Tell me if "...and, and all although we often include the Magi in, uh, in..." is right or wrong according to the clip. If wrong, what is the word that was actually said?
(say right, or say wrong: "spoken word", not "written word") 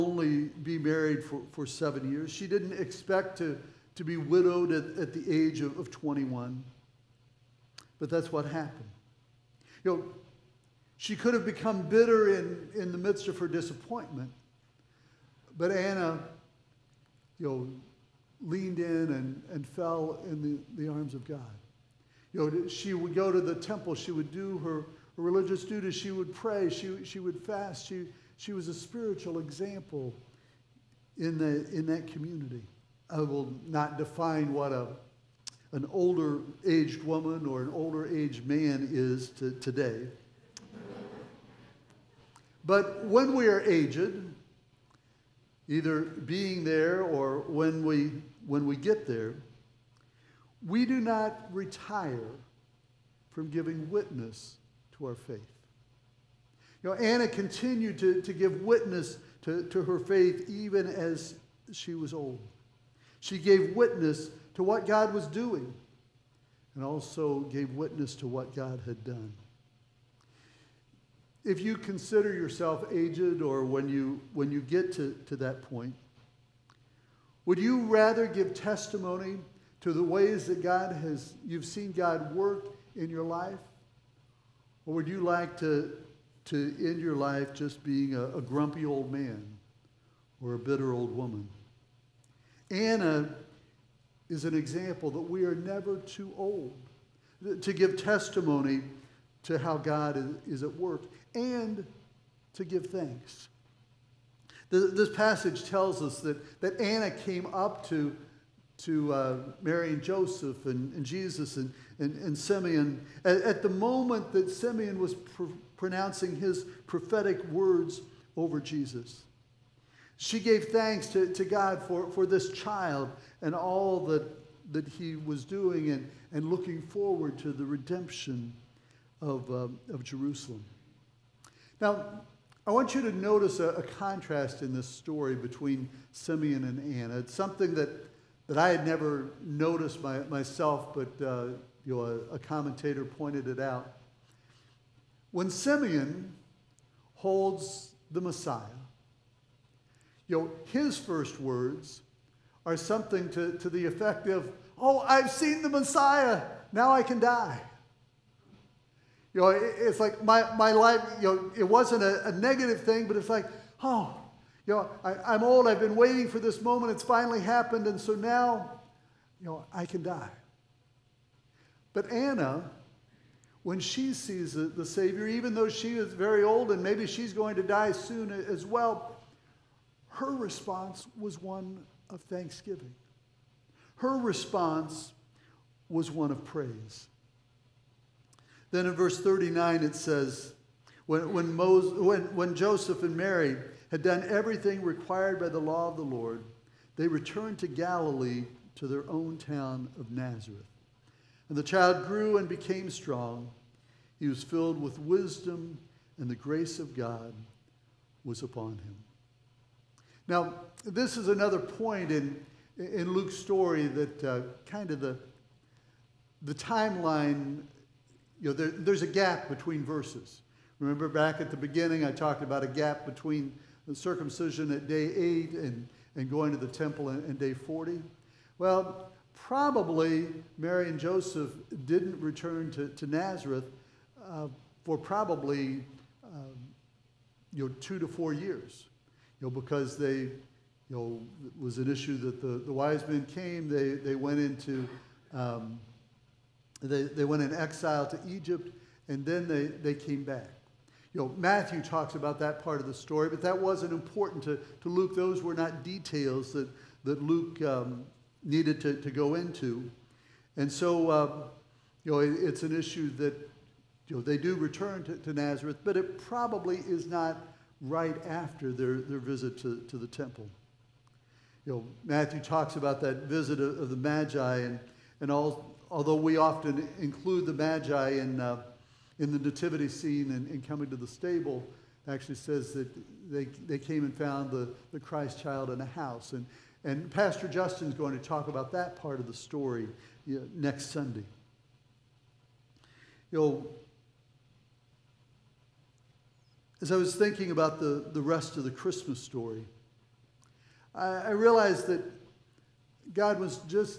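right.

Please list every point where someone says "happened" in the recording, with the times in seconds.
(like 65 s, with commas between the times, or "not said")
8 s, 167 s.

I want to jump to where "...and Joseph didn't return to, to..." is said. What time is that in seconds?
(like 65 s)
230 s.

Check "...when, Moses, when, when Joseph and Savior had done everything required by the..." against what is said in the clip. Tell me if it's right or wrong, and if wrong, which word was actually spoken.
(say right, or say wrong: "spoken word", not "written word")
wrong: "Mary", not "Savior".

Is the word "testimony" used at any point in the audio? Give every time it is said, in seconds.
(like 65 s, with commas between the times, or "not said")
78 s, 98 s.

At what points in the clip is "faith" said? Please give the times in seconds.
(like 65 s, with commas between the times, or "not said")
55 s, 59 s.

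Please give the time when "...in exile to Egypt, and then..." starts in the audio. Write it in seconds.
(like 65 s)
247 s.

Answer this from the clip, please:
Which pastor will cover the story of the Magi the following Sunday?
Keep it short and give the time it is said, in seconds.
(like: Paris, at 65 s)
Pastor Justin, at 287 s.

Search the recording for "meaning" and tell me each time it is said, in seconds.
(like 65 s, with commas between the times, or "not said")
not said.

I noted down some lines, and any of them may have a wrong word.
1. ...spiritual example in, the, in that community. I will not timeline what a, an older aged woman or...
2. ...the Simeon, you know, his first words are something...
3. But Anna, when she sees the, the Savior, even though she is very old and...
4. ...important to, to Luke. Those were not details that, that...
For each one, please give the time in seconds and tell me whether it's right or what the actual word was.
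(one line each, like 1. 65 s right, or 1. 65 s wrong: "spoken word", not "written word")
1. 28 s wrong: "define", not "timeline"
2. 148 s wrong: "Messiah", not "Simeon"
3. 171 s right
4. 253 s right.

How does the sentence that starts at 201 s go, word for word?
And the child grew and became strong.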